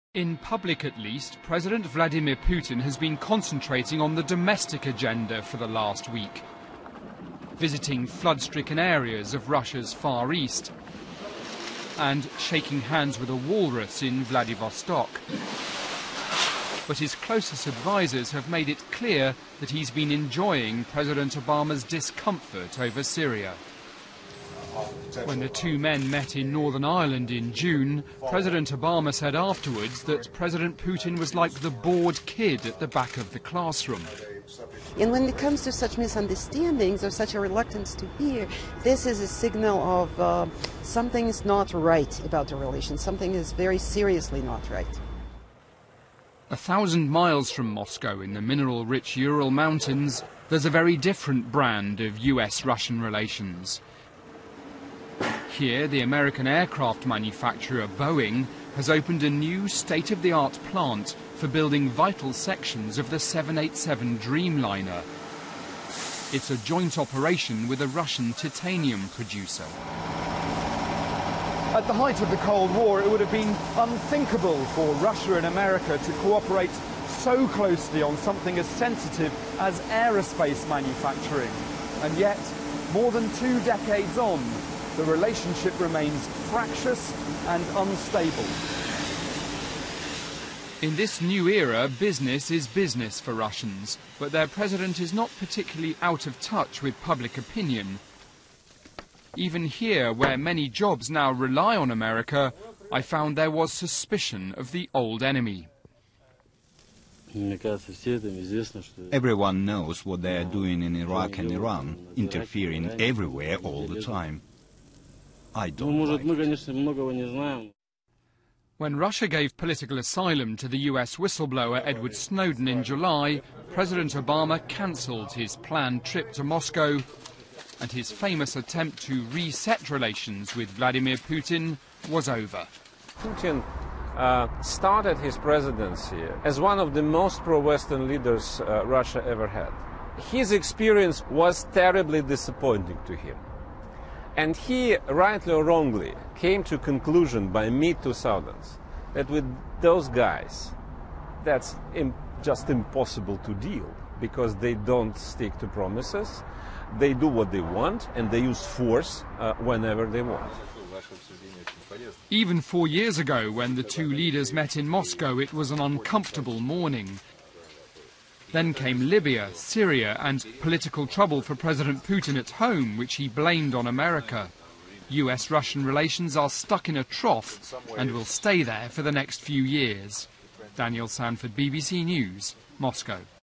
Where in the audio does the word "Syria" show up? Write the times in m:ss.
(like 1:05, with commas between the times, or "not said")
0:23, 2:49.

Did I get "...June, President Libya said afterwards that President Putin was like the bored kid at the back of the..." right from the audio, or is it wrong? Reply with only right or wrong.
wrong.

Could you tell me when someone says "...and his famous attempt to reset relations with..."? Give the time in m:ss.
2:07.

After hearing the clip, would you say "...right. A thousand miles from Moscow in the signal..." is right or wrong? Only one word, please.
wrong.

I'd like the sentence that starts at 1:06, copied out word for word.
It's a joint operation with a Russian titanium producer.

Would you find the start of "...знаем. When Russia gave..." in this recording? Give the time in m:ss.
1:57.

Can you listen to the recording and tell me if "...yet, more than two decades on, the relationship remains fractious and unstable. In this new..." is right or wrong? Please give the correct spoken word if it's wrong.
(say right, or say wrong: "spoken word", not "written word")
right.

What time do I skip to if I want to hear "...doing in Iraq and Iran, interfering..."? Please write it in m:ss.
1:50.